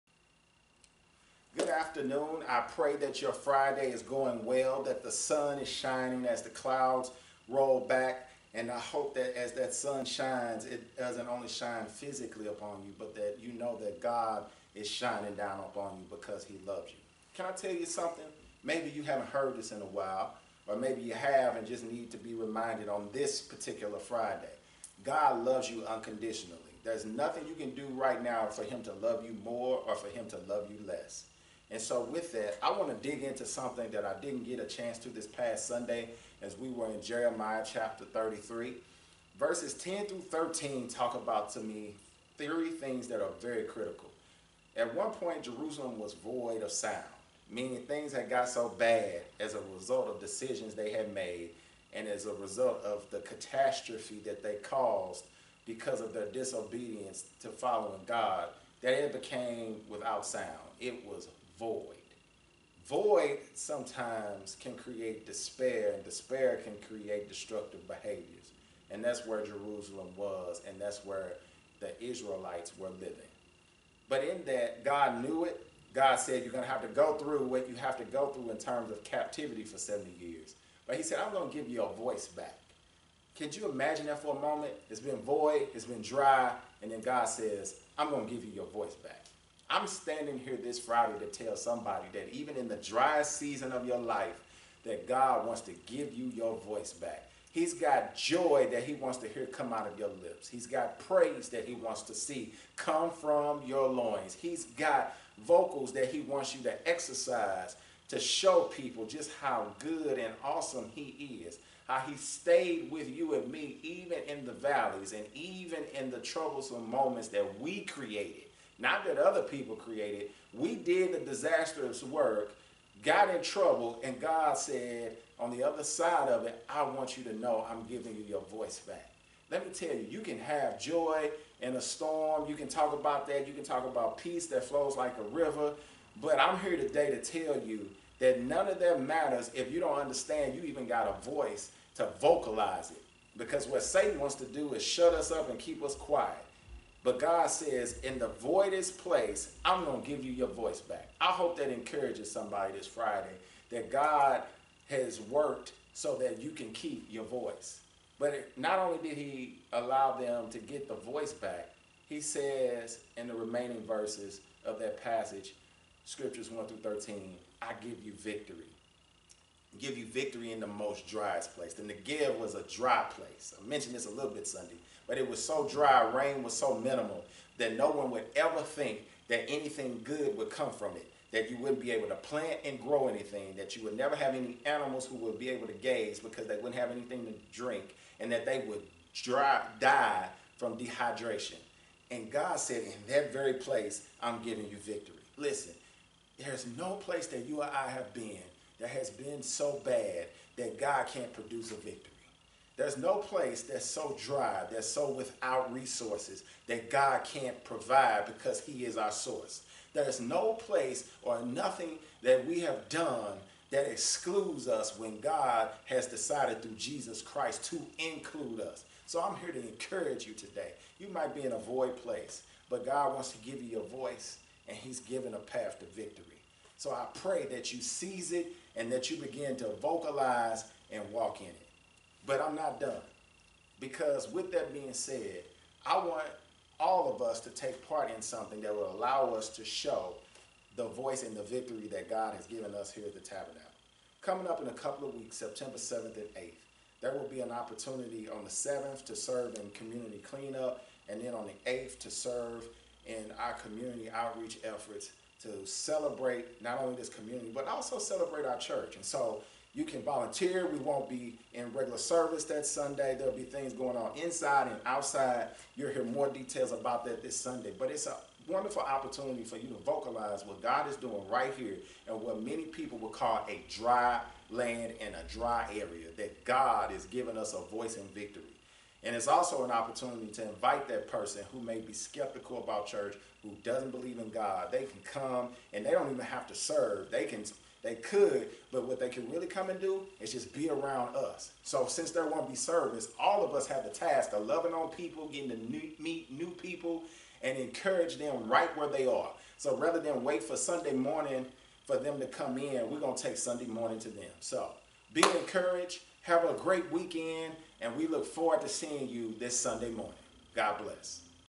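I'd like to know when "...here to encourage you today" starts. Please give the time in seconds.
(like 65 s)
219 s.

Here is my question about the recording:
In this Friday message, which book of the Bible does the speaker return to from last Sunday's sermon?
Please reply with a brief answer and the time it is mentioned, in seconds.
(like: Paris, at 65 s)
Jeremiah, at 37 s.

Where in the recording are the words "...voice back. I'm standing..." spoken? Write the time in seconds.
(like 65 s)
88 s.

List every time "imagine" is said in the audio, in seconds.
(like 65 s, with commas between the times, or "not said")
83 s.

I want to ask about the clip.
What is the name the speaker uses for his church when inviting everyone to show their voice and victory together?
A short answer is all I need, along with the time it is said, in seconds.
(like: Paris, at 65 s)
the Tabernacle, at 243 s.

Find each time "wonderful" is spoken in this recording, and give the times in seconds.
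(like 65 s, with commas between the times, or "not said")
268 s.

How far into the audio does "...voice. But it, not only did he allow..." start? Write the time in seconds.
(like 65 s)
157 s.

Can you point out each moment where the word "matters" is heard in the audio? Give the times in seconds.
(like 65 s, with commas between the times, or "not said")
139 s.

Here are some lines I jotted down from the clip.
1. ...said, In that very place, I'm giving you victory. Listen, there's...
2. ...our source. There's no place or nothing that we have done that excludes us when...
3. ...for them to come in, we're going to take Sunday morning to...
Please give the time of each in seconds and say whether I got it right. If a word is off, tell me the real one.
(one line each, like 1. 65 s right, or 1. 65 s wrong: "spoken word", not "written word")
1. 192 s right
2. 208 s right
3. 301 s right.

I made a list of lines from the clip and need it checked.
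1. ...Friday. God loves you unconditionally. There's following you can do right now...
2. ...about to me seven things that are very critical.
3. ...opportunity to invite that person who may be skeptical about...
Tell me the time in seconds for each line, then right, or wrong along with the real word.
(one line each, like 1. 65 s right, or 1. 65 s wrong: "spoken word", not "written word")
1. 23 s wrong: "nothing", not "following"
2. 41 s wrong: "three", not "seven"
3. 279 s right.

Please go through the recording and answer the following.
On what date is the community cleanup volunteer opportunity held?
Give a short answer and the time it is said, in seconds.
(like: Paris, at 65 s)
September 7, at 245 s.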